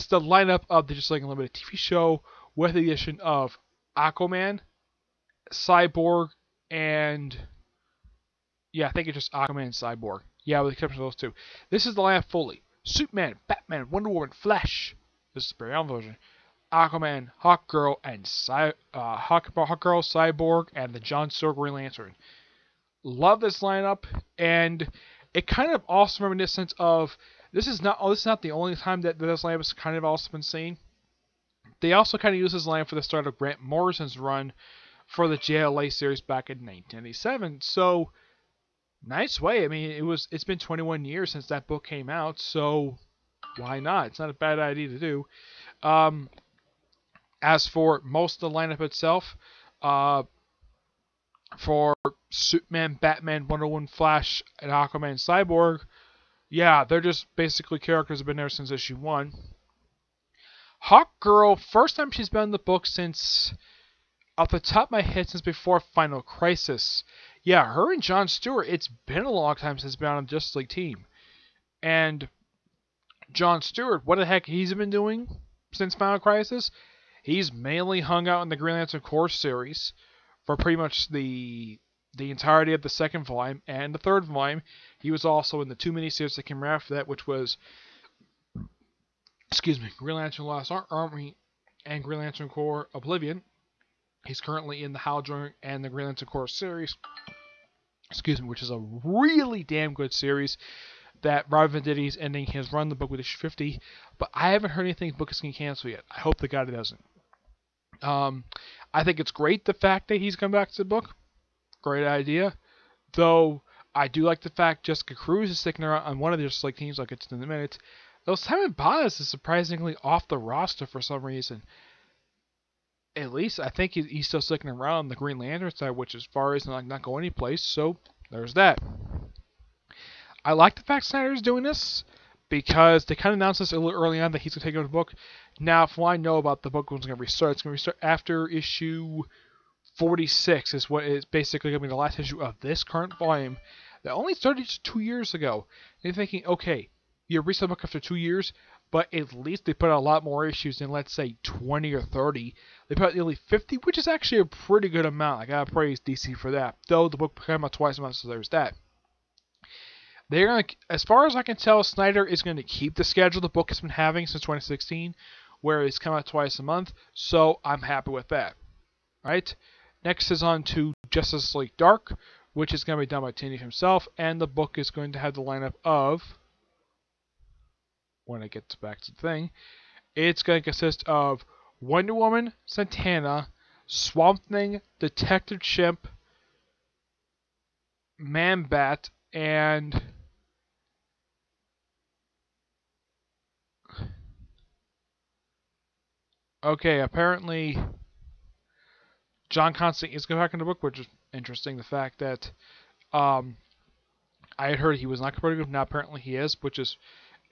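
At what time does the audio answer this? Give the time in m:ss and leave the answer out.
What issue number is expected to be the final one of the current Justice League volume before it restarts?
2:18.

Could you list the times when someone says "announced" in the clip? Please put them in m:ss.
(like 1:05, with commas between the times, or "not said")
2:13.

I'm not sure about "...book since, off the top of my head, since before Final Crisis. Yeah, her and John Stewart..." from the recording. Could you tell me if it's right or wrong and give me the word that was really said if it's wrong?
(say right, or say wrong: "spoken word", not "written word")
right.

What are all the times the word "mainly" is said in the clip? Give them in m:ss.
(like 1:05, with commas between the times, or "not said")
1:17.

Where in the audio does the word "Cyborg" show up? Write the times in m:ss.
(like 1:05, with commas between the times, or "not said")
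0:05, 0:10, 0:20, 0:55.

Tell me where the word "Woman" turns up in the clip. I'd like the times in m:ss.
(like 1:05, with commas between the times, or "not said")
0:14, 0:53, 3:02.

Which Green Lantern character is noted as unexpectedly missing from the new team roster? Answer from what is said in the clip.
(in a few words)
Simon Baz.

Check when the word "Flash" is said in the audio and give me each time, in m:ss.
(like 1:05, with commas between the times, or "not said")
0:14, 0:53.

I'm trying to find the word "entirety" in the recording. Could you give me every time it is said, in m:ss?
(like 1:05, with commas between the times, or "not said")
1:22.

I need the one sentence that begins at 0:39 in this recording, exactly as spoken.
I mean, it was it's been 21 years since that book came out, so why not?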